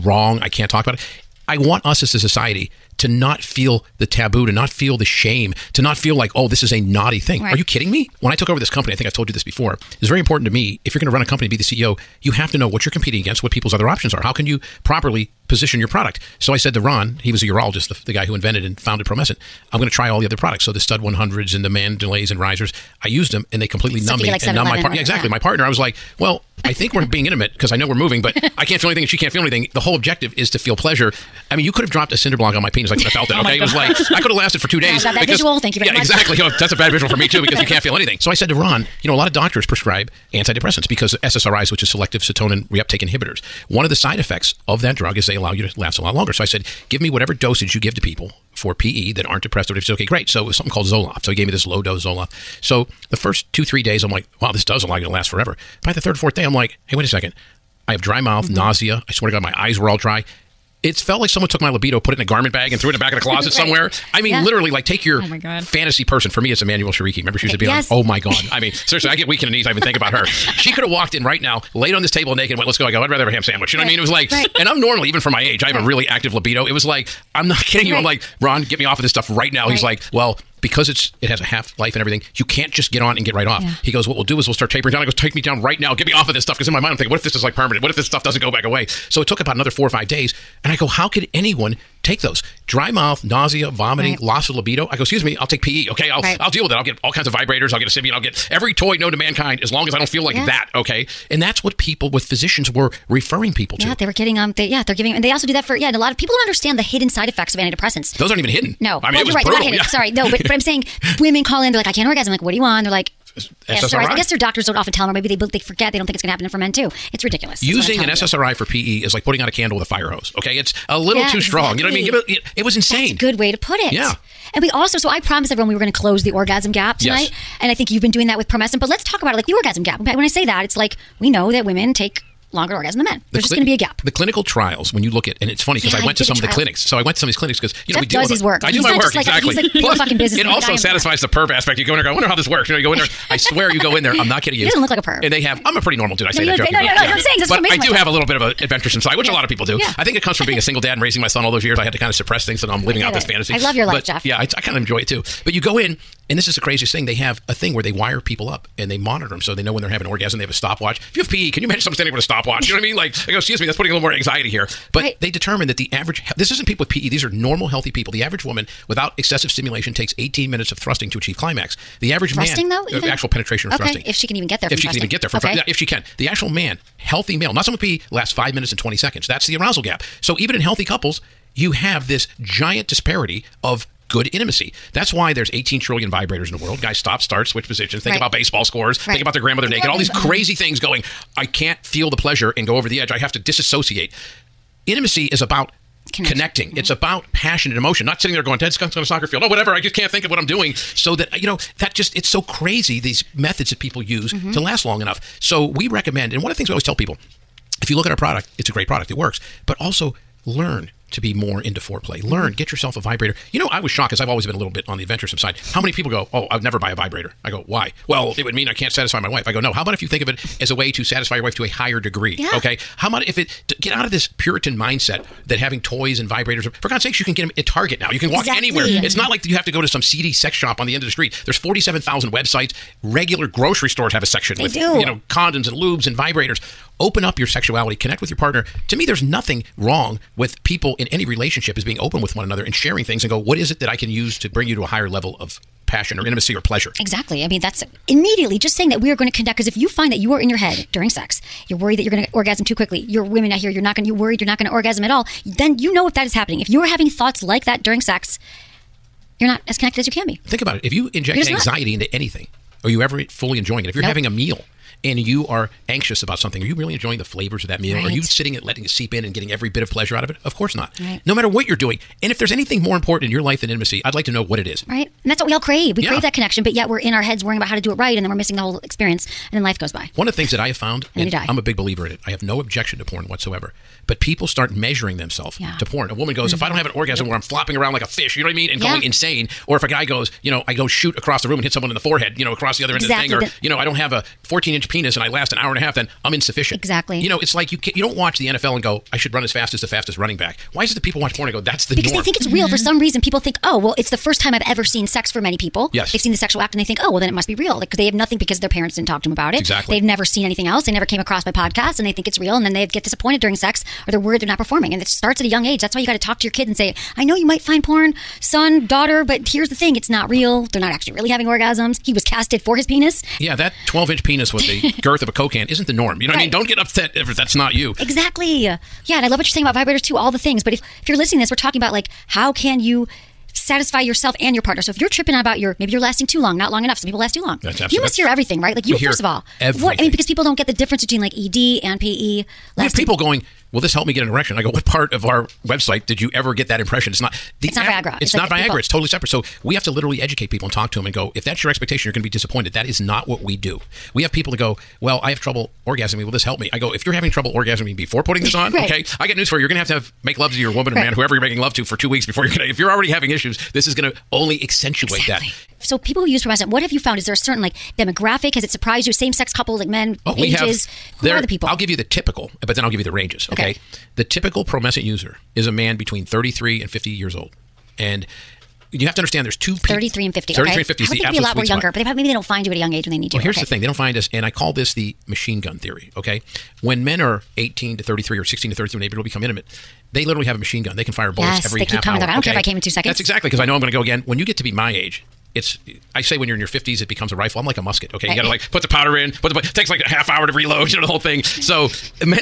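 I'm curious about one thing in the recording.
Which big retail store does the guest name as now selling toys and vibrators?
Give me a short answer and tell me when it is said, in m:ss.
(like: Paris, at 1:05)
Target, at 3:47.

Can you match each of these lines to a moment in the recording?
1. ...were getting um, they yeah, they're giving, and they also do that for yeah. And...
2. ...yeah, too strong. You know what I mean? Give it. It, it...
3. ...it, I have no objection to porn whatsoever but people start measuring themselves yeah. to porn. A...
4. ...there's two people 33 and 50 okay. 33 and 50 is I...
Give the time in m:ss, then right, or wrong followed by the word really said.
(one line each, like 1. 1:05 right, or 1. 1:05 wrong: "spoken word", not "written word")
1. 1:44 right
2. 2:01 right
3. 4:42 right
4. 6:19 right.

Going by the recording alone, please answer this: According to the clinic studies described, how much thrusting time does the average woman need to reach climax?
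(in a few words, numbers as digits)
18 minutes.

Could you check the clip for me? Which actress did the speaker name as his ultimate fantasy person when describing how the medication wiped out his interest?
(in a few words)
Emmanuelle Chriqui.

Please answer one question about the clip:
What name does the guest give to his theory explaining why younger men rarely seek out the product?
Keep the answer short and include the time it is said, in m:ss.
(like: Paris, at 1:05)
The machine gun theory, at 6:25.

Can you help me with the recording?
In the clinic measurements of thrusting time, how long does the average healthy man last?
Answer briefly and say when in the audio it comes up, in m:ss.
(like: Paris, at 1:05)
5 minutes and 20 seconds, at 2:58.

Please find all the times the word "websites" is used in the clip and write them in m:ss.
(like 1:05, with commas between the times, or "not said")
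3:52, 5:45.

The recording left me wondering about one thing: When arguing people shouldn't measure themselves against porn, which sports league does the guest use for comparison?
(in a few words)
NFL.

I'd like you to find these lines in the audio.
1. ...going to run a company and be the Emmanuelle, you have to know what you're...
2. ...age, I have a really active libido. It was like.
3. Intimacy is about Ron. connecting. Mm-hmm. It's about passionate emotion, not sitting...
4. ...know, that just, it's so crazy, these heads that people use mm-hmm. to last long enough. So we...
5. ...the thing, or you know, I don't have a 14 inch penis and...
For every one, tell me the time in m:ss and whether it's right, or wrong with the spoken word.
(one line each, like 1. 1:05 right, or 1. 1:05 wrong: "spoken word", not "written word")
1. 0:10 wrong: "CEO", not "Emmanuelle"
2. 1:15 right
3. 3:14 wrong: "Connection", not "Ron"
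4. 3:21 wrong: "methods", not "heads"
5. 4:53 right.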